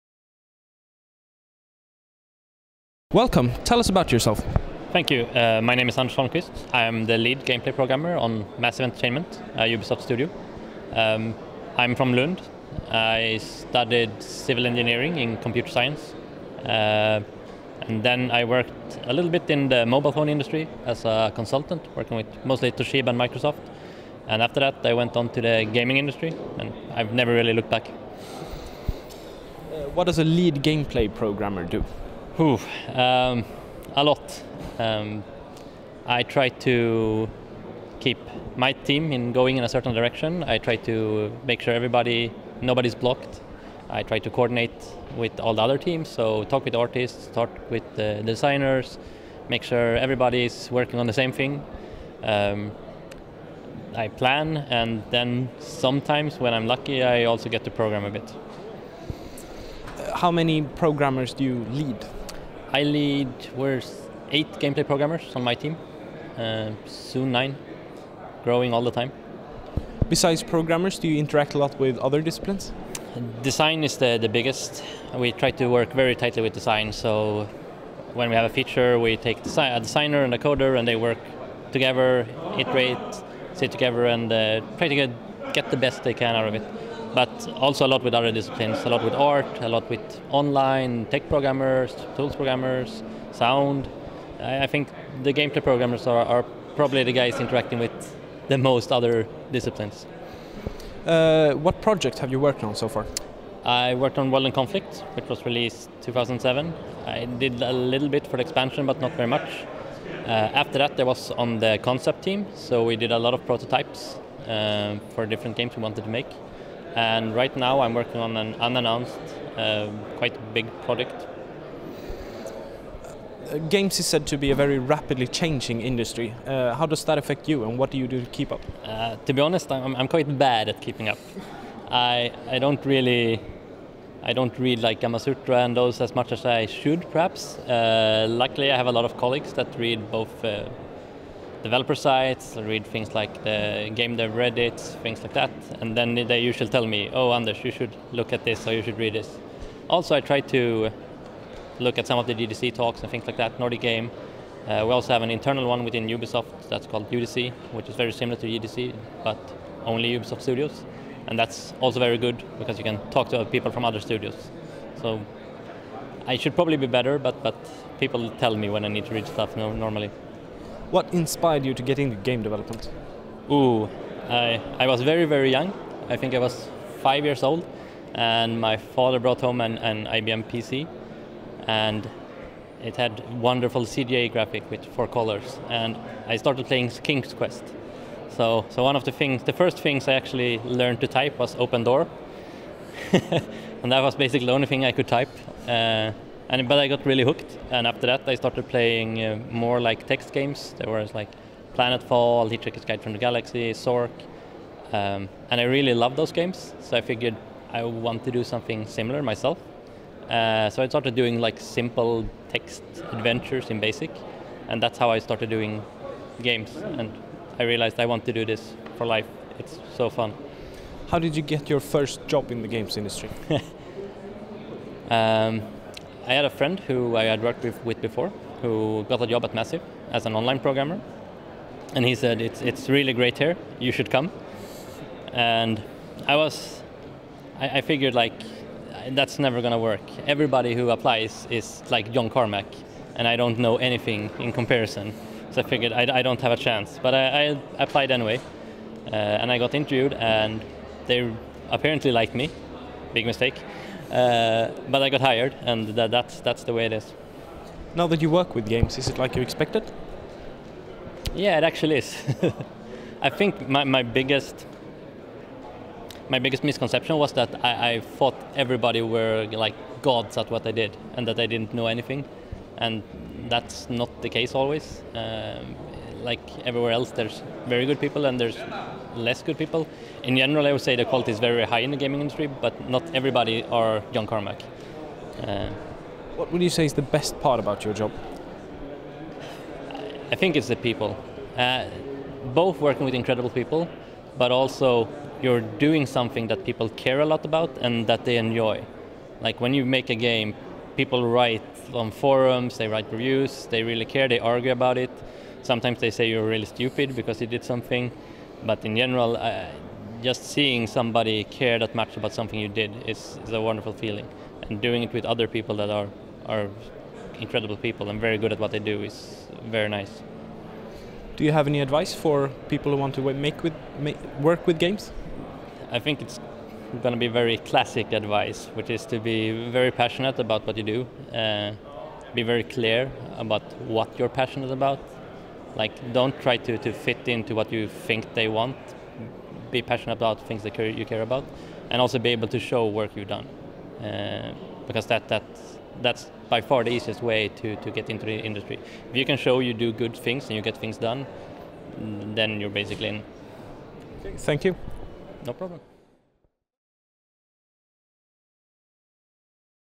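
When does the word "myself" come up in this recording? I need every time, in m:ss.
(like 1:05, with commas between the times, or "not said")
3:29.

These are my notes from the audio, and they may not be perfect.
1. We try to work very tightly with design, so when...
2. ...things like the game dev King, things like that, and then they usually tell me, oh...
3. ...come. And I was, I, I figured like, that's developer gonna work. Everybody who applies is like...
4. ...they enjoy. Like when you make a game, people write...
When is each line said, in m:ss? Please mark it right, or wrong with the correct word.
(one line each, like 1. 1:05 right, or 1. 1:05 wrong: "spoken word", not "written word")
1. 1:15 right
2. 2:22 wrong: "Reddit", not "King"
3. 3:54 wrong: "never", not "developer"
4. 4:58 right.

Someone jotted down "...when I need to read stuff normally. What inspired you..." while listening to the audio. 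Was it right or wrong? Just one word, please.
right.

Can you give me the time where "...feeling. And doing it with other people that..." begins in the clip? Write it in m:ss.
5:13.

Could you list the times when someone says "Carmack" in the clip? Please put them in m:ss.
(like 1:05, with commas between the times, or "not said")
4:02, 4:44.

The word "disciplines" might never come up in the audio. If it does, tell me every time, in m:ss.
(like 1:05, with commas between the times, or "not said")
1:12, 1:28, 1:39.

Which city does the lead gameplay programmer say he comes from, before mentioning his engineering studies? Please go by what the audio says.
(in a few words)
Lund.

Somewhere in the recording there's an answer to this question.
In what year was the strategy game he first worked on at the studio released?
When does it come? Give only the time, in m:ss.
1:46.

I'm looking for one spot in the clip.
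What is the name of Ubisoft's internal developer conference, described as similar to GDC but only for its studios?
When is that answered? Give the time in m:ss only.
2:37.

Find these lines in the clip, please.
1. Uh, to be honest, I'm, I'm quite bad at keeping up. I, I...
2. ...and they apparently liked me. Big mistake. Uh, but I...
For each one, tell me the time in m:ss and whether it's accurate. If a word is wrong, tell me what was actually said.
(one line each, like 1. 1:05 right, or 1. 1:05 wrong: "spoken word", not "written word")
1. 2:08 right
2. 4:10 right.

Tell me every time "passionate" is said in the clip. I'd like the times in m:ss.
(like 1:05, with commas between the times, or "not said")
5:29, 5:34, 5:39.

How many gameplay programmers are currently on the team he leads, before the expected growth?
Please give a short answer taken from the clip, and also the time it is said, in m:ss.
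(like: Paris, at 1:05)
8, at 1:04.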